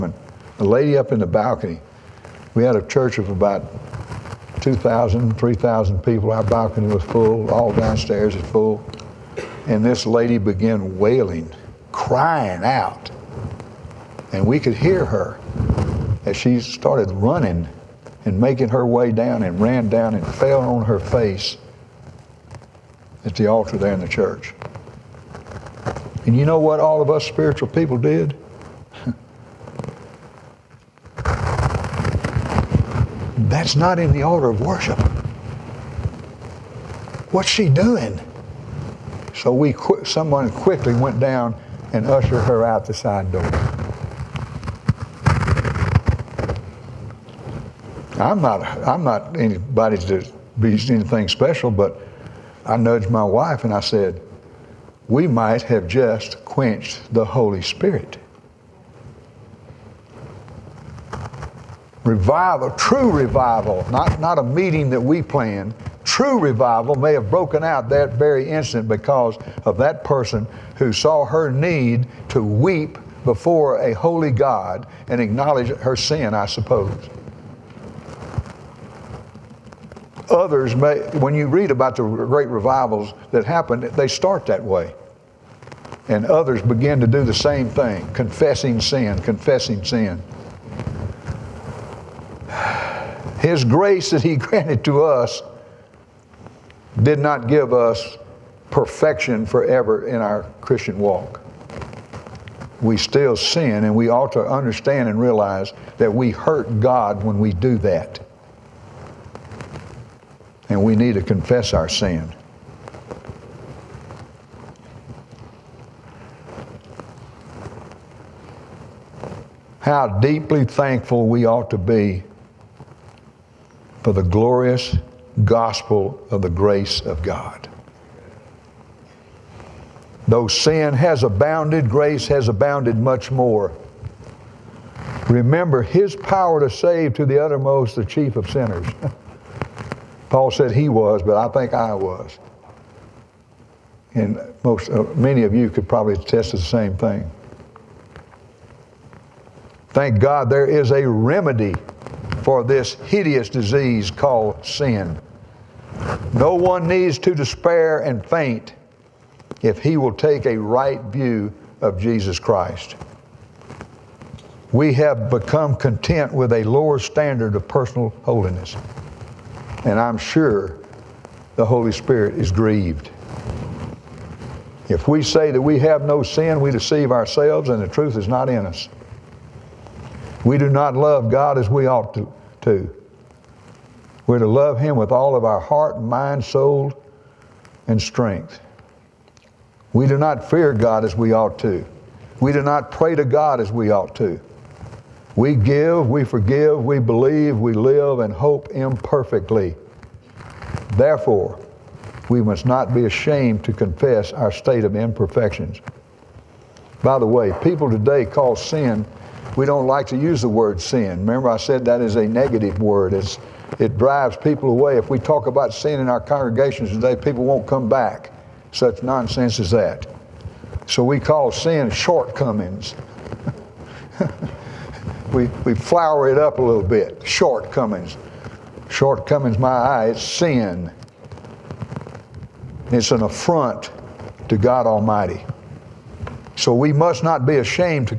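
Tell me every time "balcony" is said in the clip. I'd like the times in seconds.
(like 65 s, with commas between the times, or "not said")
1 s, 6 s.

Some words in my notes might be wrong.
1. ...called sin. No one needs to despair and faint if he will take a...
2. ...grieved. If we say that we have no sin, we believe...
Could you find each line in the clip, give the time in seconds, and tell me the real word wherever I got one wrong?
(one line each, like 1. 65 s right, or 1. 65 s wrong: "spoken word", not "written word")
1. 154 s right
2. 172 s wrong: "deceive", not "believe".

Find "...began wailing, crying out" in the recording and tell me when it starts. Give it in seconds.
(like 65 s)
10 s.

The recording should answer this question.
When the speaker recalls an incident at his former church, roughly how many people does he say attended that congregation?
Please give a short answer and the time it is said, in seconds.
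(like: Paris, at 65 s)
2,000 to 3,000, at 4 s.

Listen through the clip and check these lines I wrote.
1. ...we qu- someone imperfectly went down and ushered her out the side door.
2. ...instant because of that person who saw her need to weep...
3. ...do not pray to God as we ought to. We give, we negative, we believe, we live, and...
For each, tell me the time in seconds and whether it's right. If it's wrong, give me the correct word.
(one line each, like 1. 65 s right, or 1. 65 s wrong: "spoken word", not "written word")
1. 39 s wrong: "quickly", not "imperfectly"
2. 68 s right
3. 192 s wrong: "forgive", not "negative".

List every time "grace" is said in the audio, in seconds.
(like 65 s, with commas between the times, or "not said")
93 s, 126 s, 131 s.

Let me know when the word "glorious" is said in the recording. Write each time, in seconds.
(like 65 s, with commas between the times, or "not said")
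124 s.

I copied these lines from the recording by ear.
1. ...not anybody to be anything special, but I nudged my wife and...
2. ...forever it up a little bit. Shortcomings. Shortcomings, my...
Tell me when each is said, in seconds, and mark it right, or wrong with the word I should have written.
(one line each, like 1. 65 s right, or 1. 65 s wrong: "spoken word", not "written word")
1. 49 s right
2. 225 s wrong: "flower", not "forever".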